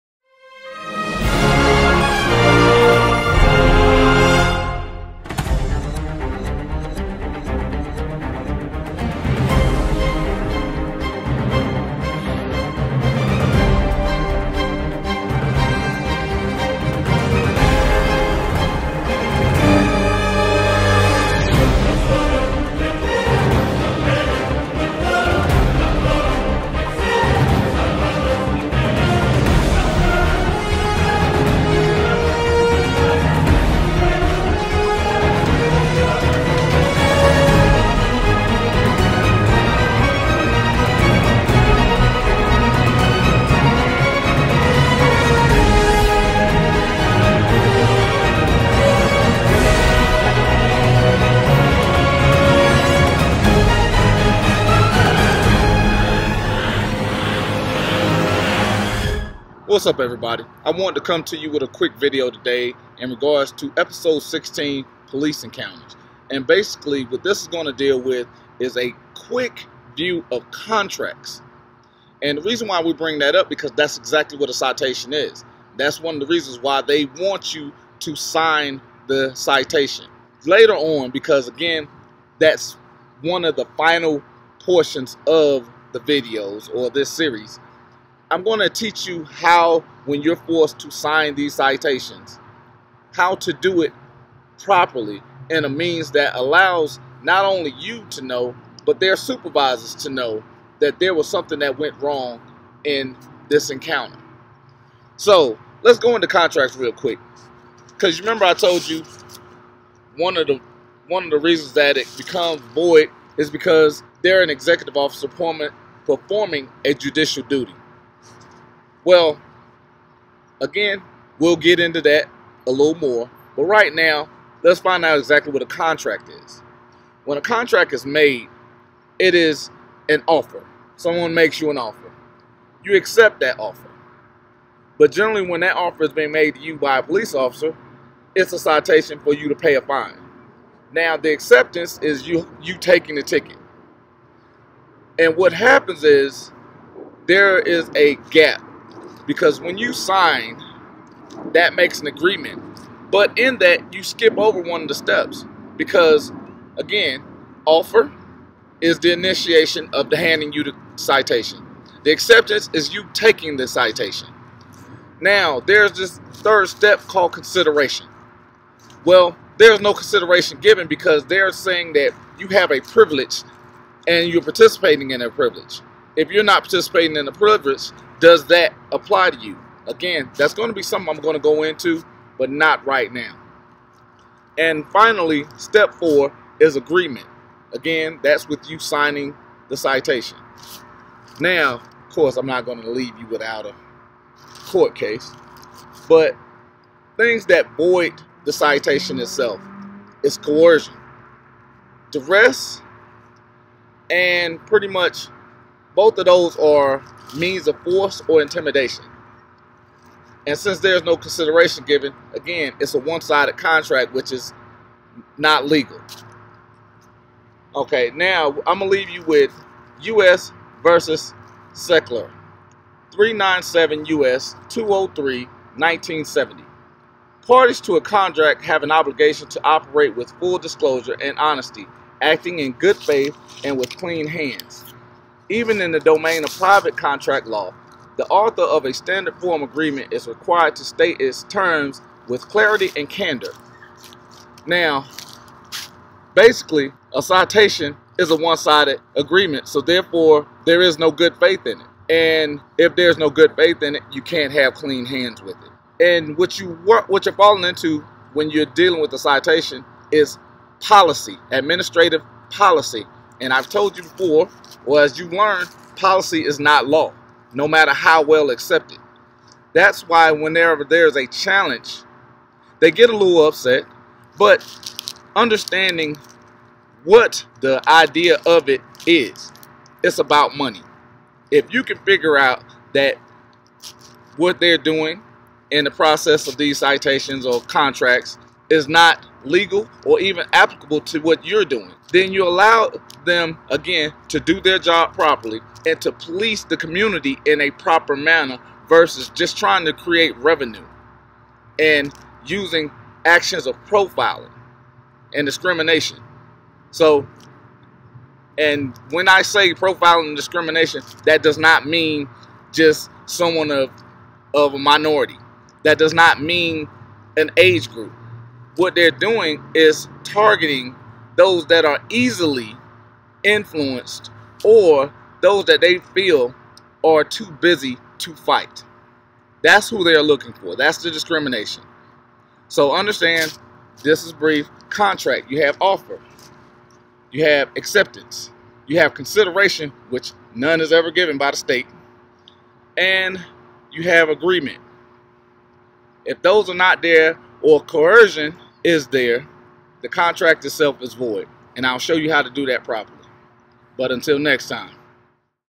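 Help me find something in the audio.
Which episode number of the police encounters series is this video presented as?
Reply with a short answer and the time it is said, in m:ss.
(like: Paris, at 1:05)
16, at 1:04.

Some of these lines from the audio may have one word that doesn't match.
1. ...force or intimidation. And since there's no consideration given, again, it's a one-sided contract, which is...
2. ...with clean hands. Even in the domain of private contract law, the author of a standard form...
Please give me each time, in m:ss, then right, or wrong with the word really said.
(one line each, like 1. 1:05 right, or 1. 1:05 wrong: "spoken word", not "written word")
1. 3:27 right
2. 3:53 right.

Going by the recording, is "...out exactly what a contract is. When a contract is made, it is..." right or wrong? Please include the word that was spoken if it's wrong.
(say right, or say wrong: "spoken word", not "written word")
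right.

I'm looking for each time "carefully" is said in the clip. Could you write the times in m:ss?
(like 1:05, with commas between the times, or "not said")
not said.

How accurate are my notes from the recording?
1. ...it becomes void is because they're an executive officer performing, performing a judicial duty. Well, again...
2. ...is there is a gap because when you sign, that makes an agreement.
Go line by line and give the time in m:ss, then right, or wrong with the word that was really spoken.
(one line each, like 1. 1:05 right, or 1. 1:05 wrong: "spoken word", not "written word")
1. 1:51 right
2. 2:26 right.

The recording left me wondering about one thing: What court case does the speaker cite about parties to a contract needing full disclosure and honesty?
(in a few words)
U.S. versus Seckinger.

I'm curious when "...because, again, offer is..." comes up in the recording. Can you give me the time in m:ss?
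2:35.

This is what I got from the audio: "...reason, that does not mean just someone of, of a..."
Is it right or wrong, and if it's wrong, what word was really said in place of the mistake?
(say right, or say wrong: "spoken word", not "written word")
wrong: "discrimination", not "reason".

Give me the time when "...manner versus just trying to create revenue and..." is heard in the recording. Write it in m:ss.
4:58.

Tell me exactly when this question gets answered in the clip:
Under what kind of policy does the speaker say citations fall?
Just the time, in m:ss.
4:21.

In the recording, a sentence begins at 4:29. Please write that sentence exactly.
That's why whenever there's a challenge, they get a little upset, but understanding what the idea of it is, it's about money.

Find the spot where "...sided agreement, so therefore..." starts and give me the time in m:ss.
4:08.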